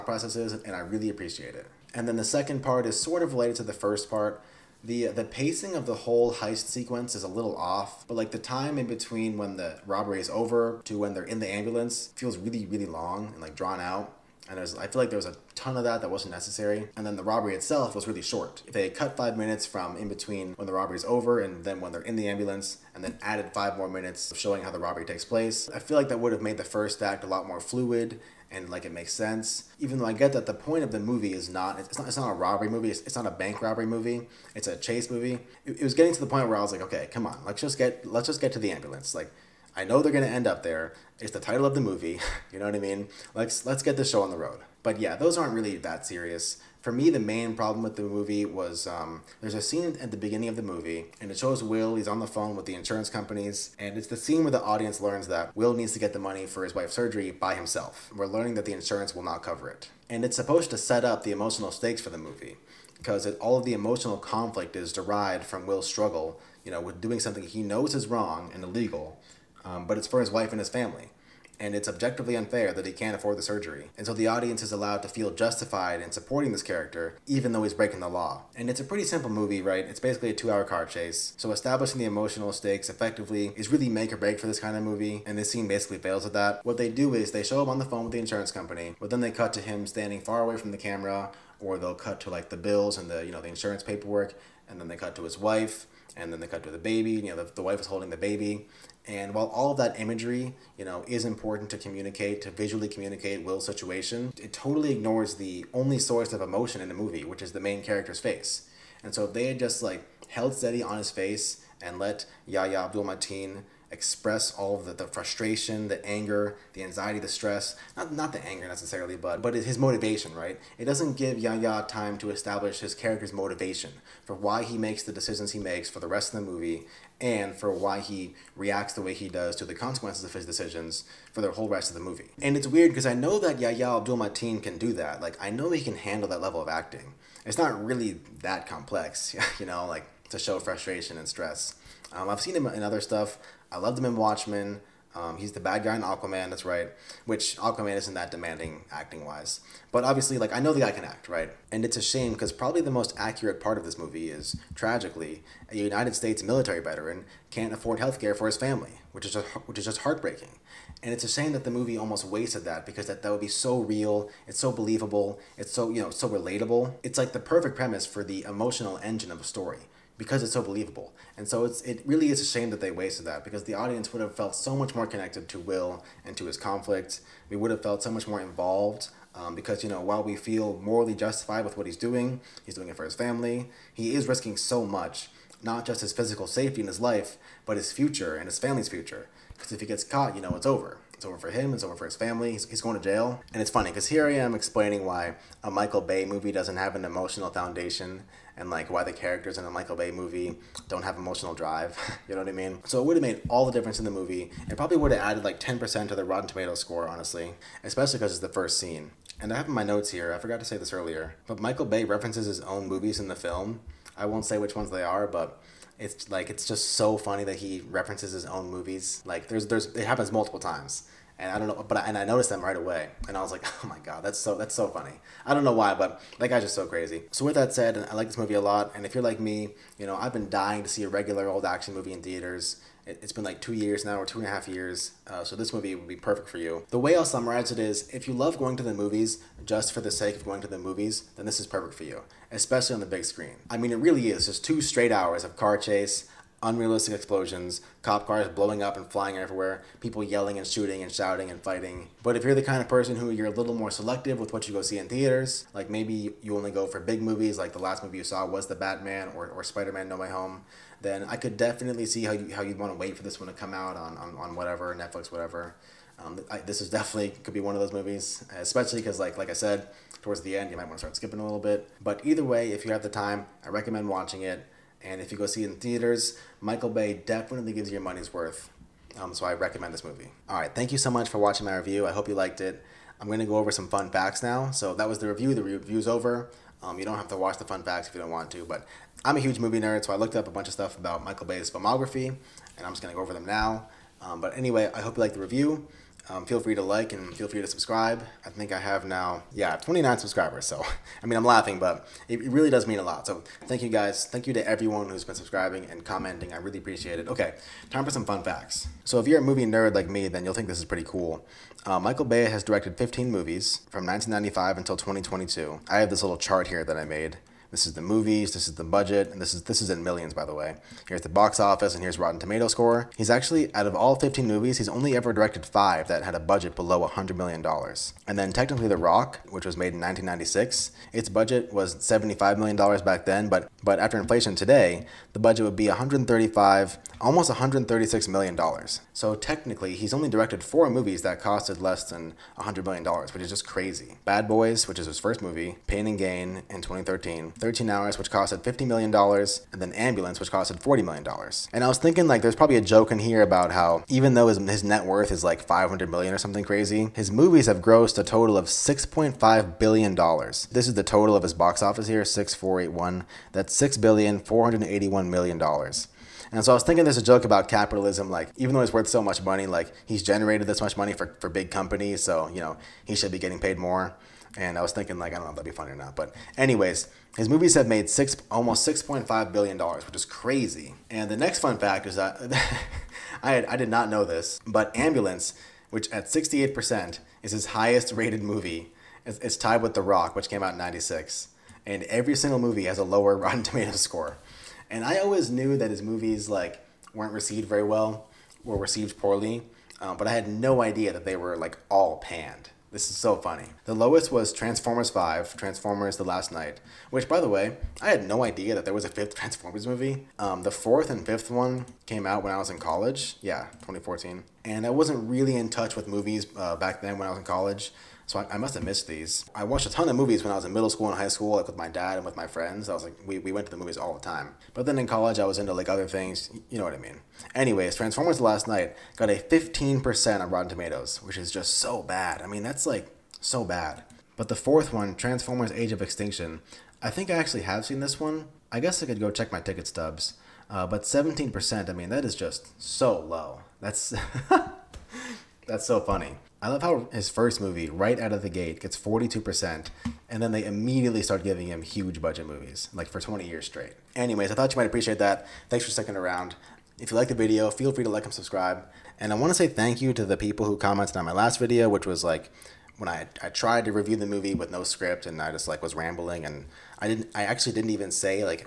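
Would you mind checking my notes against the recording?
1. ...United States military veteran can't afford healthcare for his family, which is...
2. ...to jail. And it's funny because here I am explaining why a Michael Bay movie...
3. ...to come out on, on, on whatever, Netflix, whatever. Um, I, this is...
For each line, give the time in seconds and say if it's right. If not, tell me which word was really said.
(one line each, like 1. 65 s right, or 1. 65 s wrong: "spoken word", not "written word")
1. 155 s right
2. 192 s right
3. 263 s right.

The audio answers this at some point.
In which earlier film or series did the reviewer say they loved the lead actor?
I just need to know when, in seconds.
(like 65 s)
144 s.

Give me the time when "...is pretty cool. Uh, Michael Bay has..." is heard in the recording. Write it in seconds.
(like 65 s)
310 s.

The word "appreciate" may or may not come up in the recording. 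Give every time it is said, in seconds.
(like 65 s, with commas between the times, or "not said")
1 s, 306 s, 454 s.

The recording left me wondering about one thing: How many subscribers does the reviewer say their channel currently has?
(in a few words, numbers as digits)
29.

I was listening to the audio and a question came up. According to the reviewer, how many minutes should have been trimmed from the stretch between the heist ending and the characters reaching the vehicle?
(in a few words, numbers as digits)
5.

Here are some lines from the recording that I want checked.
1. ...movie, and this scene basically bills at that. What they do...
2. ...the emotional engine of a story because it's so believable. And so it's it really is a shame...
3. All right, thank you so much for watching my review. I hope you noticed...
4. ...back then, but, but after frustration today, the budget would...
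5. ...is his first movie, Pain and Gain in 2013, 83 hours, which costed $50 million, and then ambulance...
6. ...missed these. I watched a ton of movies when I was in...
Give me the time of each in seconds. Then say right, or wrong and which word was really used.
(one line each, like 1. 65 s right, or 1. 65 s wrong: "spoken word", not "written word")
1. 84 s wrong: "fails", not "bills"
2. 168 s right
3. 280 s wrong: "liked", not "noticed"
4. 332 s wrong: "inflation", not "frustration"
5. 344 s wrong: "13", not "83"
6. 418 s right.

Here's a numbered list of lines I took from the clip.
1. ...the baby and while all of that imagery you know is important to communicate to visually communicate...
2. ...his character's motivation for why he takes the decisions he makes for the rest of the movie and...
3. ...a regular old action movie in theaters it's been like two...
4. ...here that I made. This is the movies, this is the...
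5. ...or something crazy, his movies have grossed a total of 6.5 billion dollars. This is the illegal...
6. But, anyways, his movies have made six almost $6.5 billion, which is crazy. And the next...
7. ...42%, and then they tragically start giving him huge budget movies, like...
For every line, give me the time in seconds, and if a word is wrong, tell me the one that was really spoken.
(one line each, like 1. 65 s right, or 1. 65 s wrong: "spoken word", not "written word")
1. 98 s right
2. 122 s wrong: "makes", not "takes"
3. 231 s right
4. 316 s right
5. 356 s wrong: "total", not "illegal"
6. 376 s right
7. 448 s wrong: "immediately", not "tragically".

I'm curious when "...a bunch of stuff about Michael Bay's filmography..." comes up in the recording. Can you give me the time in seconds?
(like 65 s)
290 s.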